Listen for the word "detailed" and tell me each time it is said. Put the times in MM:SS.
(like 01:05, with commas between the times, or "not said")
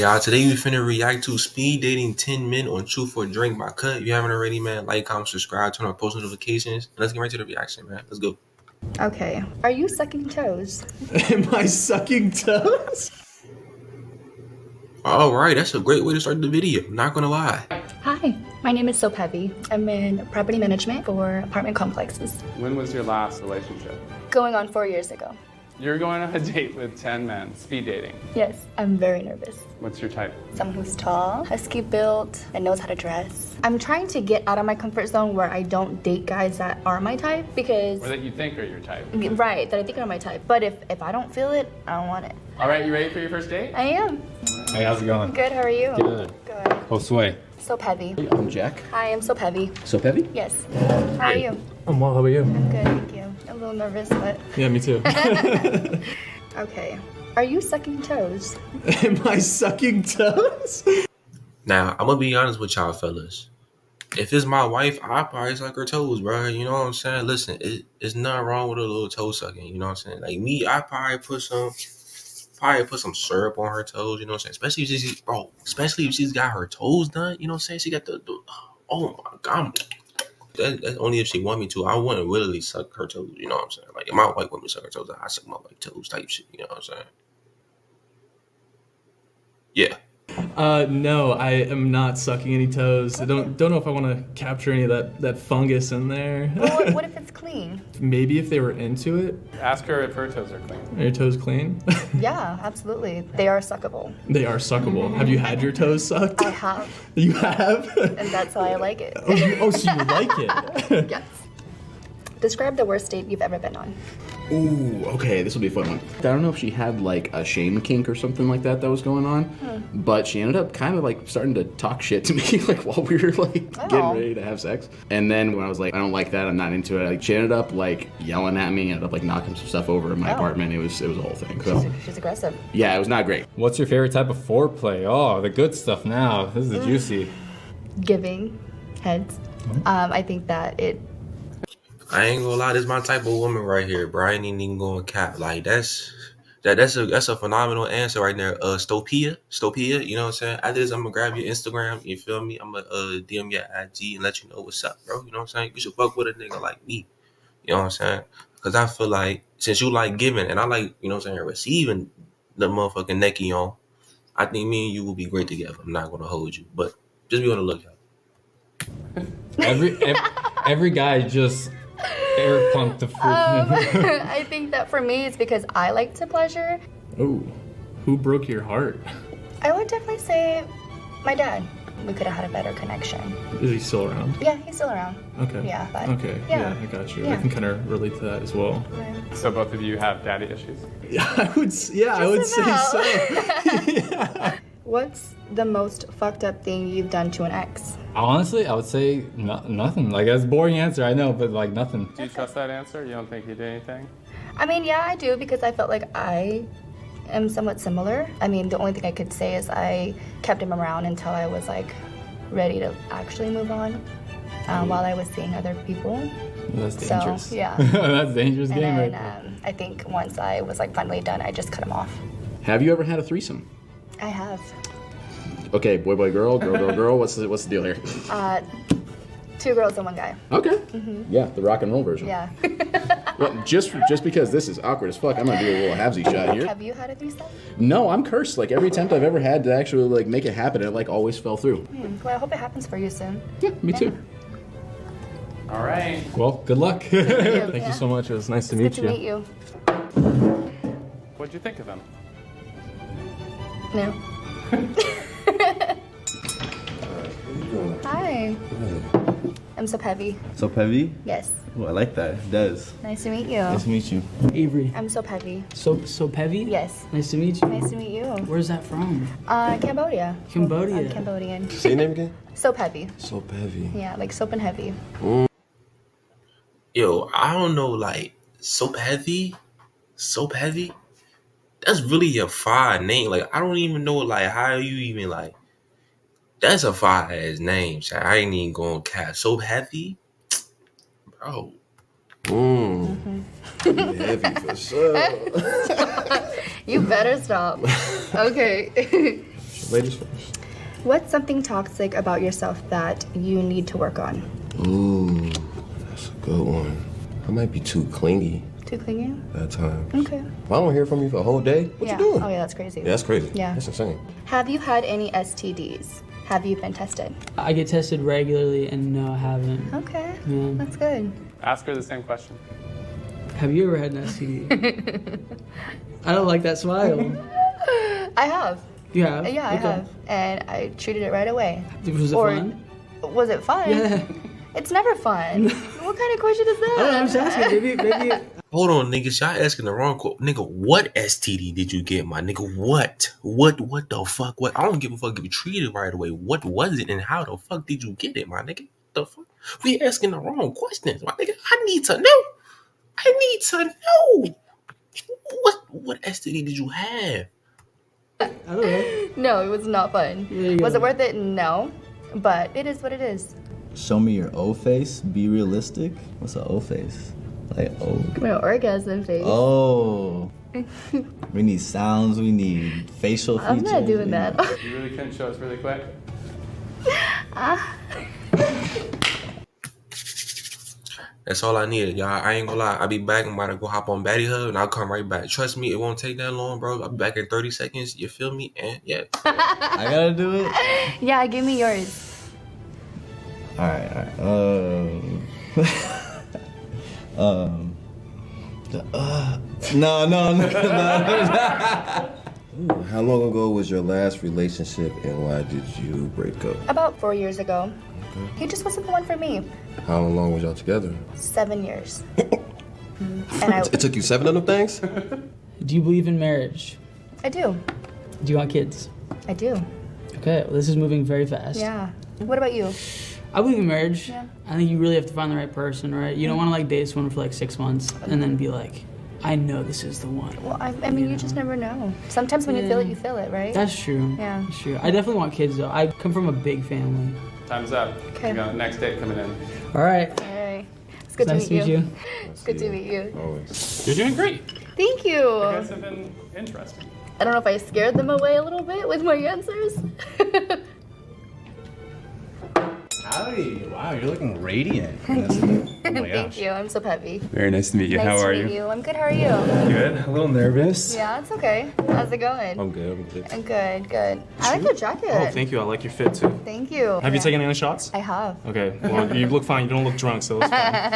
not said.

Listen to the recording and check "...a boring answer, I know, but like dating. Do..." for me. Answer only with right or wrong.
wrong.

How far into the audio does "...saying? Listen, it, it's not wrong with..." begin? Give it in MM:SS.
01:06.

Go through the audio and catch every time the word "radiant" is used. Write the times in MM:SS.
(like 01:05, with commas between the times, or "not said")
07:34.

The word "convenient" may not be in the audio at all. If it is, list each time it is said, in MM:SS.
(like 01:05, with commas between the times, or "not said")
not said.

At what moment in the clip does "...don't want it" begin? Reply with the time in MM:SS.
00:41.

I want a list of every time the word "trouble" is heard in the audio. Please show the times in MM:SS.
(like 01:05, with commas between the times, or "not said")
not said.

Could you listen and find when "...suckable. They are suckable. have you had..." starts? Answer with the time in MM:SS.
01:43.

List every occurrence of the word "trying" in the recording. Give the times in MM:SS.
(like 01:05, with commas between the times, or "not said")
00:33.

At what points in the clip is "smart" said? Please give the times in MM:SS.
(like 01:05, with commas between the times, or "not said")
not said.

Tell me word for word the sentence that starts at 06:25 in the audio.
Trust me, it won't take that long, bro.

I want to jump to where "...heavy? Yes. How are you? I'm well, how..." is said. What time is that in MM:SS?
00:49.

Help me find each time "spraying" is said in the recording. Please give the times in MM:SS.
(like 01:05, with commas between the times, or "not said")
not said.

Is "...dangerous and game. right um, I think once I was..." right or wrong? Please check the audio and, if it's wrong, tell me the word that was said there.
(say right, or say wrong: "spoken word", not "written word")
right.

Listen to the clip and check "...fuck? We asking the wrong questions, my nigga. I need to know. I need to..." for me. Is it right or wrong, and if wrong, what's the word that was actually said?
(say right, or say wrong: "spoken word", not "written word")
right.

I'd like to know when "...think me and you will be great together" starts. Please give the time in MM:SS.
02:44.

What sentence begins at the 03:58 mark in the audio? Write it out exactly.
Like every attempt I've ever had to actually like make it happen, it like always fell through.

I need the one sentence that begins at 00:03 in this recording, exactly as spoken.
If you haven't already, man, like, comment, subscribe, turn on post notifications.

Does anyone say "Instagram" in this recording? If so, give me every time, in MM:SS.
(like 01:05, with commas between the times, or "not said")
02:31.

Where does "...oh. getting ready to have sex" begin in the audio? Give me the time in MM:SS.
02:03.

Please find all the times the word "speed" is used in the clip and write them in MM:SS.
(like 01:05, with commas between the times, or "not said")
00:01, 00:27.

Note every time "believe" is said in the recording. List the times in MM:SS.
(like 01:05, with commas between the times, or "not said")
06:56, 07:03.